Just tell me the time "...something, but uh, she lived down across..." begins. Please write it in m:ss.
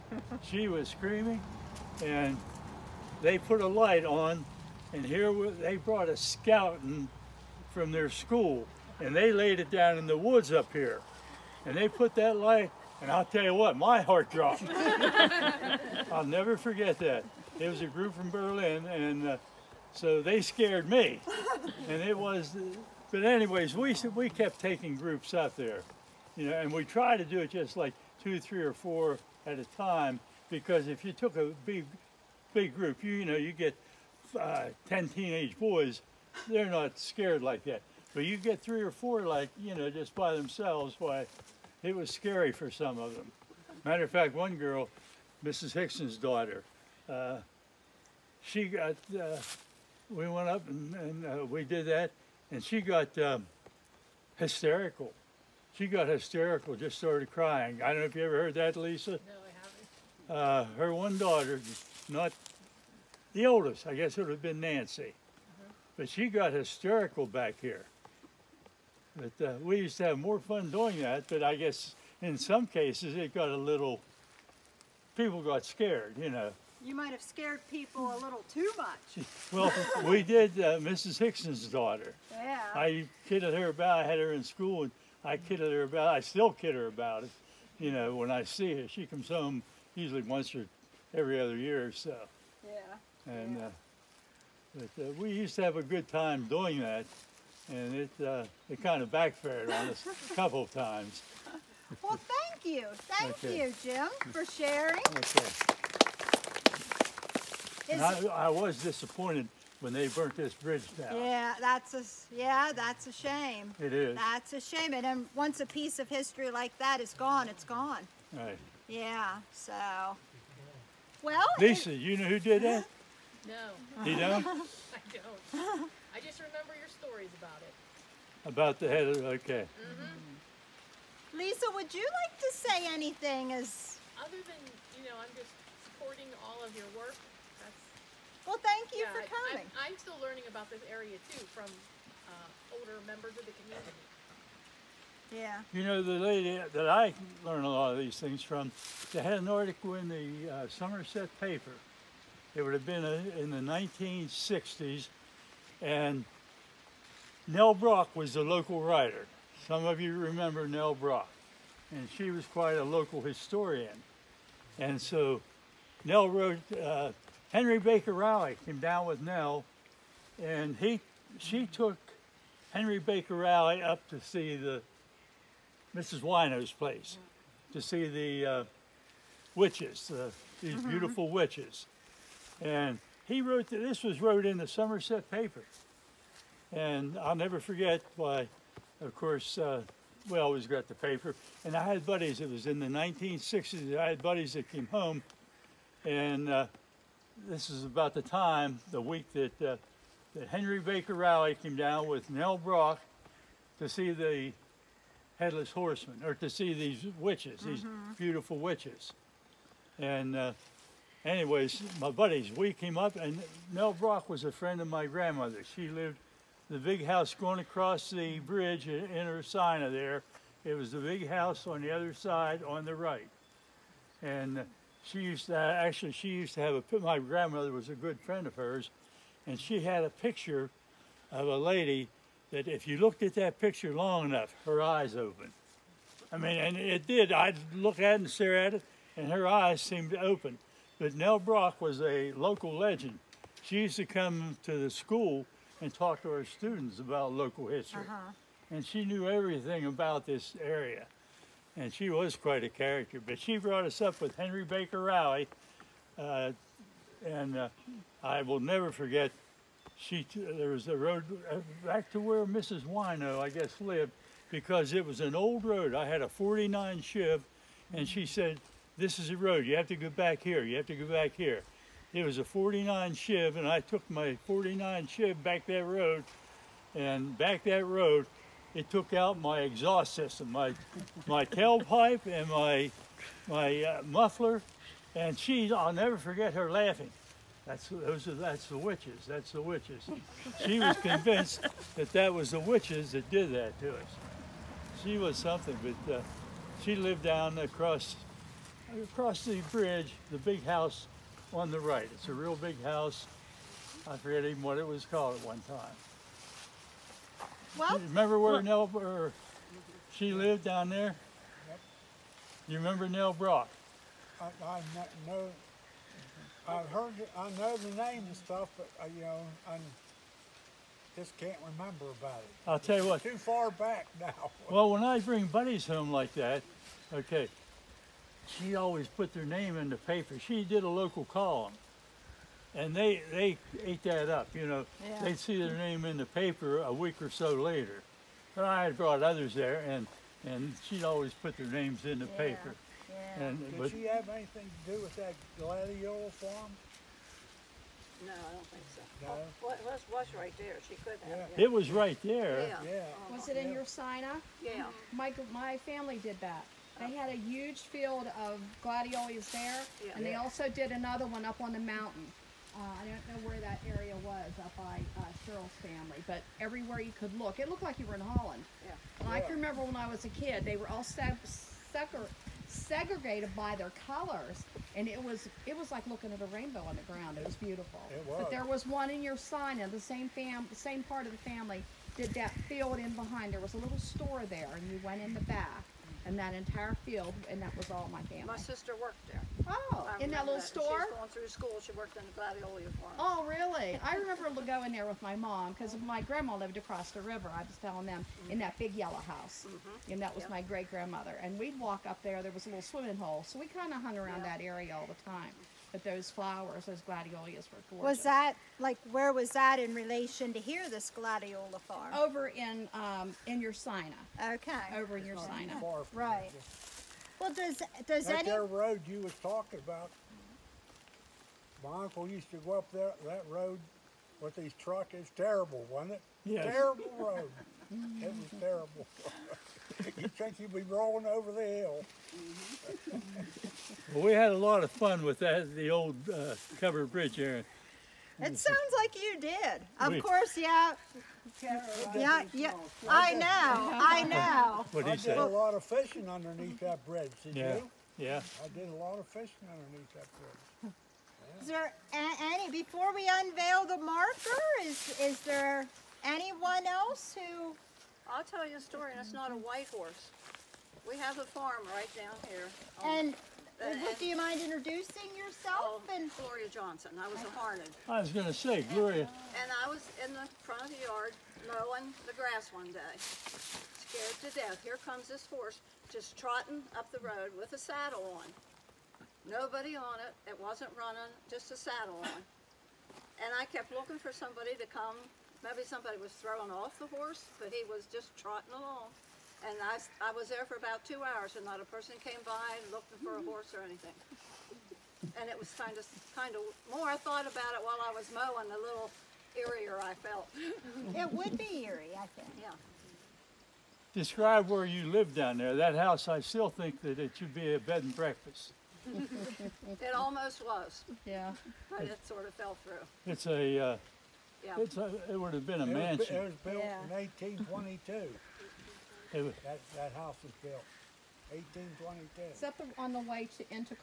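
4:55.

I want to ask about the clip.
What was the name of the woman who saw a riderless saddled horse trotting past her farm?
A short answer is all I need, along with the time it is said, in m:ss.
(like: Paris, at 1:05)
Gloria Johnson, at 7:46.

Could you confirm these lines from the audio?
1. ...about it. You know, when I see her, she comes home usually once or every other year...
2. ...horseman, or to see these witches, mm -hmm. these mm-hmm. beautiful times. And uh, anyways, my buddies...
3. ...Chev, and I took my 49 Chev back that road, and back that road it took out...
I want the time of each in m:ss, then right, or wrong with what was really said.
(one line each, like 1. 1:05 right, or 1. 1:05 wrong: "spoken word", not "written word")
1. 1:26 right
2. 3:25 wrong: "witches", not "times"
3. 4:33 right.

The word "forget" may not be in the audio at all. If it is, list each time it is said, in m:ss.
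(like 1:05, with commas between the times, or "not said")
0:16, 3:07, 4:18, 4:46, 5:04.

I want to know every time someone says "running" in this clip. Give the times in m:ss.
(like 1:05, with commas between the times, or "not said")
8:00.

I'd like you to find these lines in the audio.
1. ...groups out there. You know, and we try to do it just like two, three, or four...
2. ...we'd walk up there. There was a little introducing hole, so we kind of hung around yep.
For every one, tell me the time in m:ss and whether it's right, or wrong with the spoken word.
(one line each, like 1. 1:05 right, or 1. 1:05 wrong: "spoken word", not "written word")
1. 0:24 right
2. 6:41 wrong: "swimming", not "introducing".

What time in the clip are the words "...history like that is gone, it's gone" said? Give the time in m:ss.
1:56.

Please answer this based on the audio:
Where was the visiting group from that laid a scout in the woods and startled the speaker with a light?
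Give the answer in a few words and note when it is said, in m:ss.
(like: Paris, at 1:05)
Berlin, at 0:18.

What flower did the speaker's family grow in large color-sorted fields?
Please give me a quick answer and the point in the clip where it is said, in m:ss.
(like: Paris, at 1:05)
Gladiolus, at 5:58.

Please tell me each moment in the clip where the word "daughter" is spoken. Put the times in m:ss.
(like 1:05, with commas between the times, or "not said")
0:46, 1:01, 1:21.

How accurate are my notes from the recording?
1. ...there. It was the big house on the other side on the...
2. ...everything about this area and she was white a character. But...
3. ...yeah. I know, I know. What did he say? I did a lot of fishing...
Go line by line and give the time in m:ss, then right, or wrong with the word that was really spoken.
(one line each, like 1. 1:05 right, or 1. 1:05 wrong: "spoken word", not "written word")
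1. 3:39 right
2. 4:09 wrong: "quite", not "white"
3. 7:22 right.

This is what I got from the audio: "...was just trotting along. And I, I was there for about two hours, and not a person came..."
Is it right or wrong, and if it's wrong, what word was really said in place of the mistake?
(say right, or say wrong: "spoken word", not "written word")
right.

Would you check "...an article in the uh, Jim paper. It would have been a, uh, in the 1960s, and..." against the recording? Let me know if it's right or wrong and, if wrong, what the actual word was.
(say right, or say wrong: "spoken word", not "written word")
wrong: "Somerset", not "Jim".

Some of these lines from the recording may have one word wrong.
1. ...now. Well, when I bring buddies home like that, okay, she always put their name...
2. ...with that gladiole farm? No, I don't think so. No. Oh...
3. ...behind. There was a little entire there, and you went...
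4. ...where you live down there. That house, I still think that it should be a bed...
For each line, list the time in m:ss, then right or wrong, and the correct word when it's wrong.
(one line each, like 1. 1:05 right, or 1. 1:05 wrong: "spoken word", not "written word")
1. 5:24 right
2. 5:45 right
3. 6:23 wrong: "store", not "entire"
4. 8:24 right.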